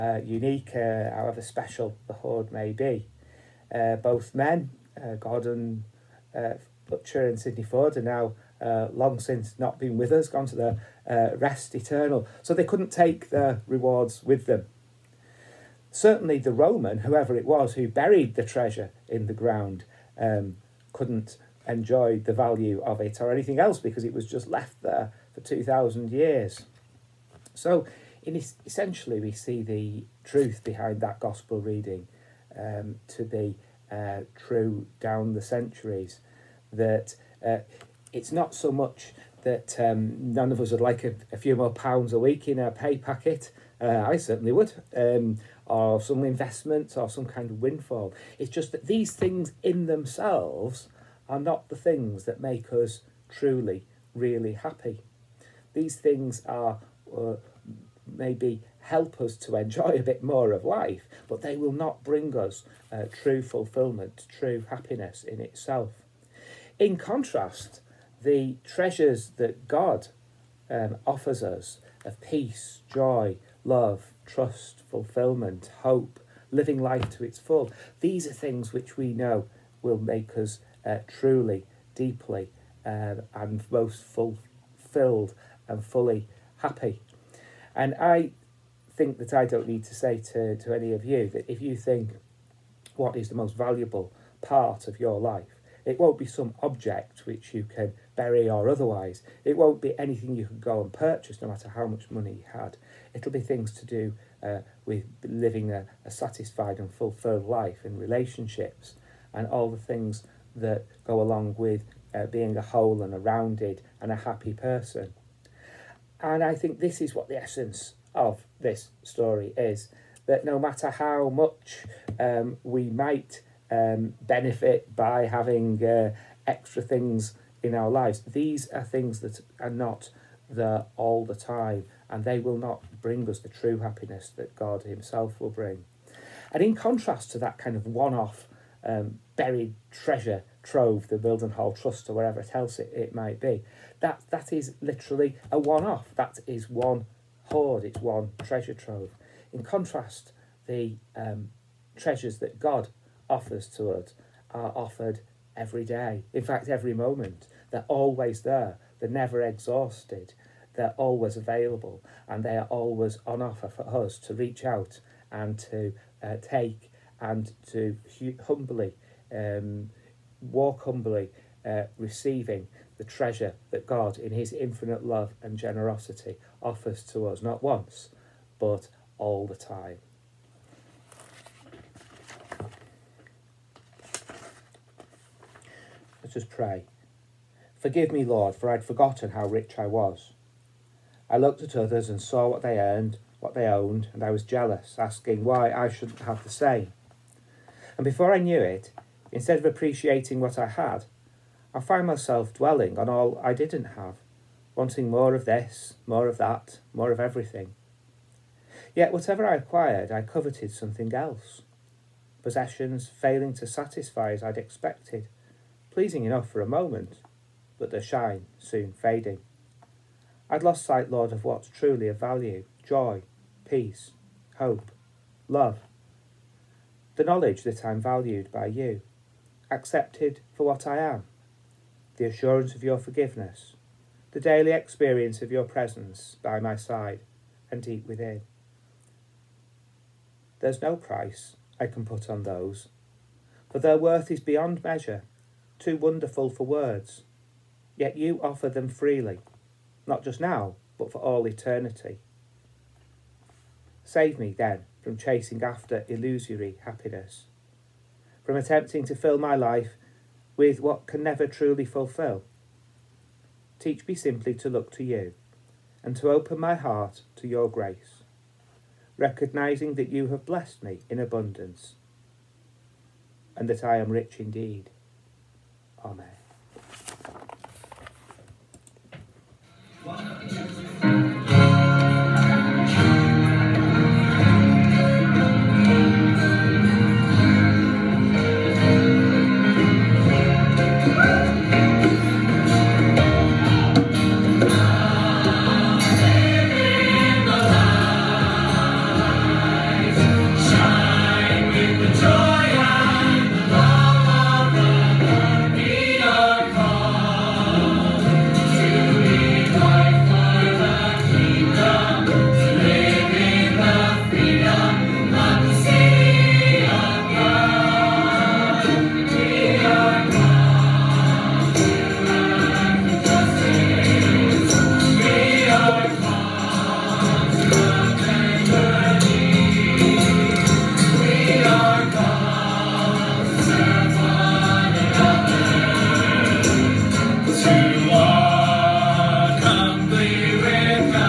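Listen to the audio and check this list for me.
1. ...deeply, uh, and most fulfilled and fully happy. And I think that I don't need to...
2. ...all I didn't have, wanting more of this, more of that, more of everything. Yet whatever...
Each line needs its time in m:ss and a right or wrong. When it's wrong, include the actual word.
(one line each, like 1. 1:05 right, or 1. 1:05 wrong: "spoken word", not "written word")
1. 1:21 right
2. 3:23 right.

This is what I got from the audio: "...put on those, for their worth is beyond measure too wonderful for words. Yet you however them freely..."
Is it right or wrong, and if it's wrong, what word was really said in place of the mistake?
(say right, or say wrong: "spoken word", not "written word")
wrong: "offer", not "however".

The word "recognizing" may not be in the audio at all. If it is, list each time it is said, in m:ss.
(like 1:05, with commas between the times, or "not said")
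4:29.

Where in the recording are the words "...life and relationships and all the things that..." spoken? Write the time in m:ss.
1:47.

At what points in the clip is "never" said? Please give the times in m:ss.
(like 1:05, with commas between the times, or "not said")
2:39, 4:21.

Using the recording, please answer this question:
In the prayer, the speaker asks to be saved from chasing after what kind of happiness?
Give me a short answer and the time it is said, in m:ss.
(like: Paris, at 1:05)
illusory happiness, at 4:16.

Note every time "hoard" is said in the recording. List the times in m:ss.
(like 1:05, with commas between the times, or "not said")
0:02, 2:27.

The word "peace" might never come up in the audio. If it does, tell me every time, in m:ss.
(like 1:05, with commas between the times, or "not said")
1:12, 3:43.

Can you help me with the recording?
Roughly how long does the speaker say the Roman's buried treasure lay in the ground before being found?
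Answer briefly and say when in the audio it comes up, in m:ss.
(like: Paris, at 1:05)
2,000 years, at 0:25.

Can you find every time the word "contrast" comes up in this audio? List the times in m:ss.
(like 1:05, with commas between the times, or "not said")
1:06, 2:16, 2:29.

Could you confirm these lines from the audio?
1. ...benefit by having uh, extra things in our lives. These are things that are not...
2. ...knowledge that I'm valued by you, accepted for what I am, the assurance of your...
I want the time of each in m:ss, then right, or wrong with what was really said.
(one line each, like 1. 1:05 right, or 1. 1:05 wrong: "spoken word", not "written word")
1. 2:04 right
2. 3:47 right.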